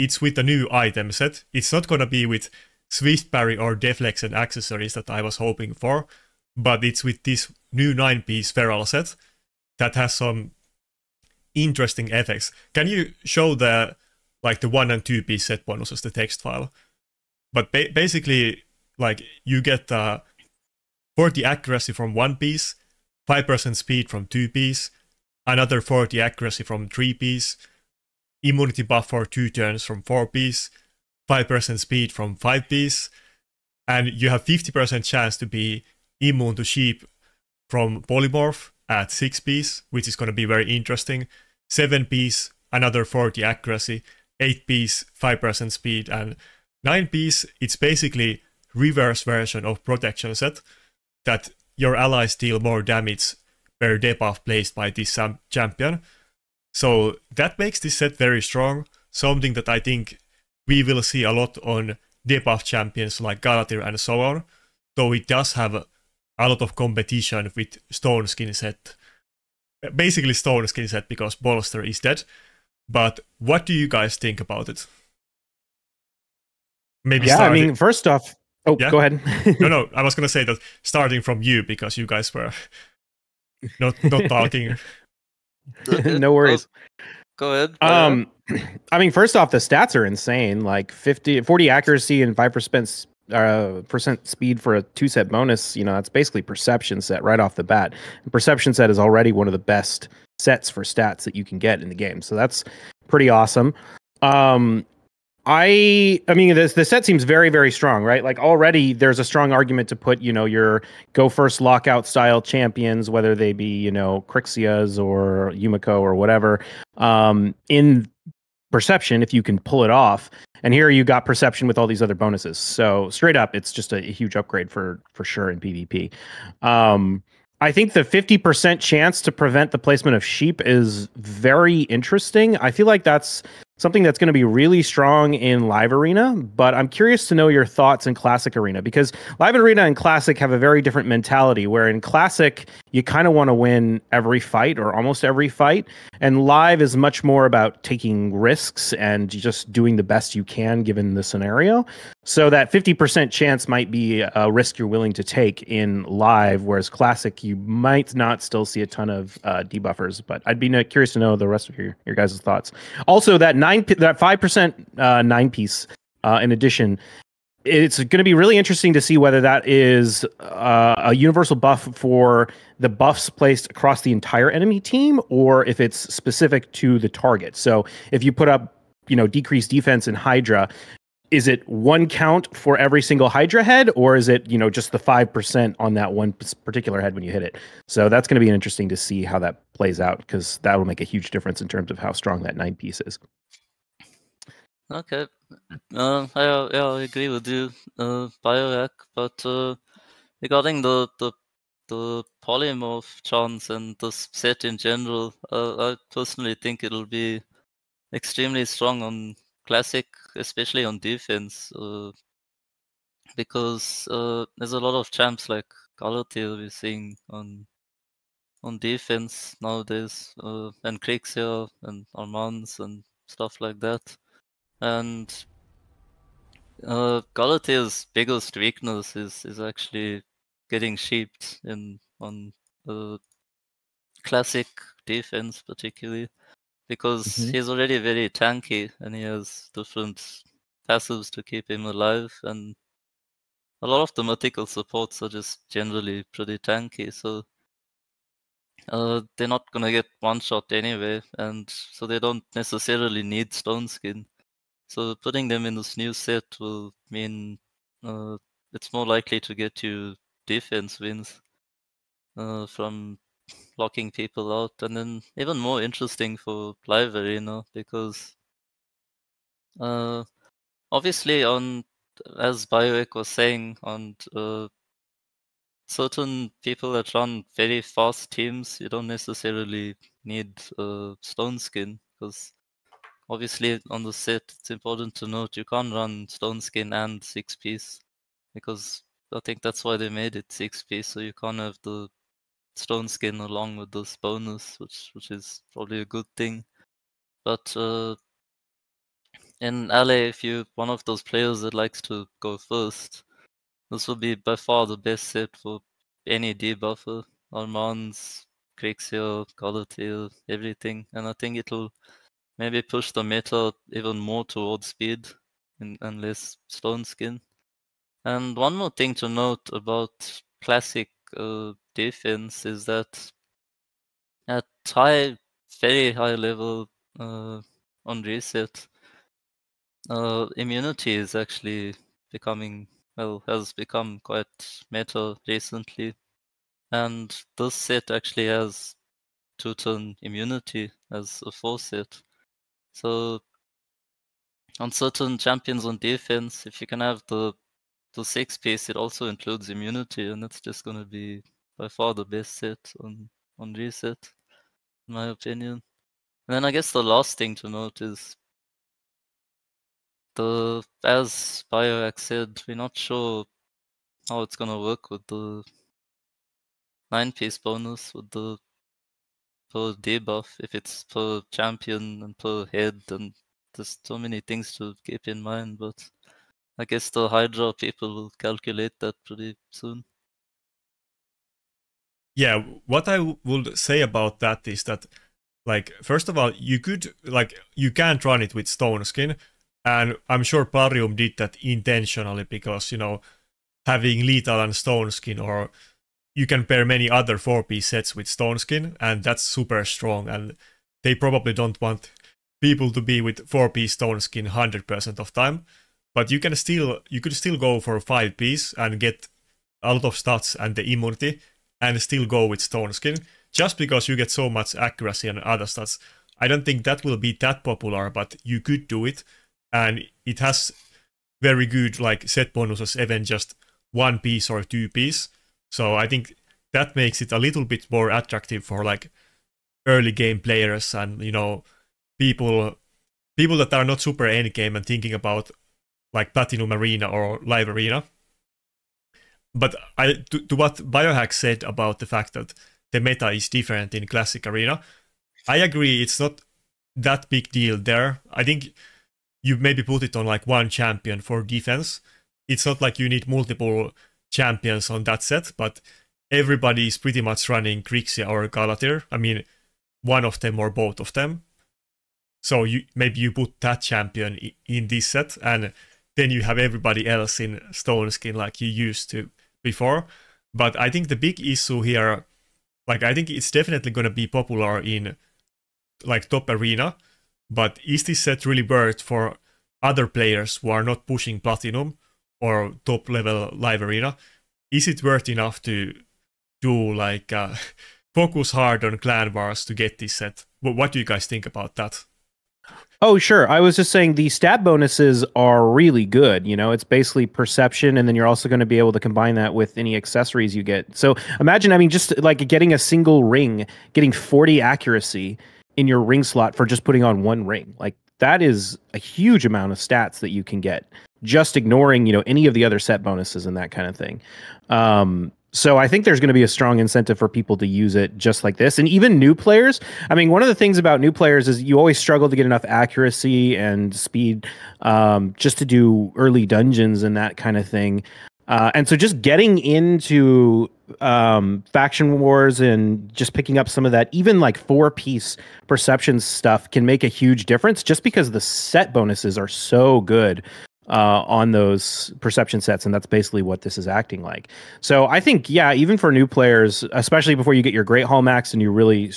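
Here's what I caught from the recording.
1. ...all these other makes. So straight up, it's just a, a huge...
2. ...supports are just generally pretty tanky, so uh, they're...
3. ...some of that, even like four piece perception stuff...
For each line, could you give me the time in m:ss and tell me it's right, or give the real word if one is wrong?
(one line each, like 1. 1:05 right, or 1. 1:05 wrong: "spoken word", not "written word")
1. 2:01 wrong: "bonuses", not "makes"
2. 4:04 right
3. 8:53 right.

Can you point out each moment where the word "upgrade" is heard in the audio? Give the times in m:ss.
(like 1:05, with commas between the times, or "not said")
2:04.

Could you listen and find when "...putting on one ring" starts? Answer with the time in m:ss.
8:26.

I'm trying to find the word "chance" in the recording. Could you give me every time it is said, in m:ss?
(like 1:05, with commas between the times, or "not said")
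0:35, 2:08, 2:33, 3:23.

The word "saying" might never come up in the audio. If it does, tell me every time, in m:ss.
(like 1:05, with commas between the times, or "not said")
4:33, 8:13.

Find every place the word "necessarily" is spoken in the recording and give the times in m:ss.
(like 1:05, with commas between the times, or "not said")
4:12, 4:39.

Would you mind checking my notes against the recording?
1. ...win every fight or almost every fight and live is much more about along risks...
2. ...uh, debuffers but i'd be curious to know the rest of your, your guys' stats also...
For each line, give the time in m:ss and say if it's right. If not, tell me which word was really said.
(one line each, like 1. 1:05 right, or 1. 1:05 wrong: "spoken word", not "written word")
1. 2:23 wrong: "taking", not "along"
2. 2:39 wrong: "thoughts", not "stats".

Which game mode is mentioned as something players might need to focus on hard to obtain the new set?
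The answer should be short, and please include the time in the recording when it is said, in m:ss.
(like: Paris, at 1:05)
Clan wars, at 8:08.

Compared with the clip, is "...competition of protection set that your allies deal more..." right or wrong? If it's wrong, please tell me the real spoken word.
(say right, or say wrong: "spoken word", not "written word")
wrong: "version", not "competition".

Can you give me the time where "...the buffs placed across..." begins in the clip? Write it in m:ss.
2:52.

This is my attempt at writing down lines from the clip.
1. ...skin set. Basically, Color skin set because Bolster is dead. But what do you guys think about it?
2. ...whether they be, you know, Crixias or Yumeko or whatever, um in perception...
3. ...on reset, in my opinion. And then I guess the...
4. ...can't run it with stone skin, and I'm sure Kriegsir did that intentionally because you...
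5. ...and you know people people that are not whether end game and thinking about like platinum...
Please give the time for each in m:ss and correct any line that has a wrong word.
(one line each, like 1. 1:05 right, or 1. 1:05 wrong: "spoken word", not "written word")
1. 1:08 wrong: "Stone", not "Color"
2. 1:53 right
3. 5:53 right
4. 6:27 wrong: "Plarium", not "Kriegsir"
5. 7:10 wrong: "super", not "whether".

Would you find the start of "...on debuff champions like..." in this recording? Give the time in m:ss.
1:01.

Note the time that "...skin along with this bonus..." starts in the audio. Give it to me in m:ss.
4:53.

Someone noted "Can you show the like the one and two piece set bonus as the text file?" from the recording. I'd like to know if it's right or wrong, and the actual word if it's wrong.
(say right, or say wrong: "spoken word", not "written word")
right.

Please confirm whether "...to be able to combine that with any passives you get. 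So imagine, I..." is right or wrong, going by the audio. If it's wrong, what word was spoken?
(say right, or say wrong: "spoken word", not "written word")
wrong: "accessories", not "passives".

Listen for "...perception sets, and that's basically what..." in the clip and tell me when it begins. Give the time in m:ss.
9:02.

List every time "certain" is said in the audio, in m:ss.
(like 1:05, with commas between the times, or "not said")
4:35, 5:44.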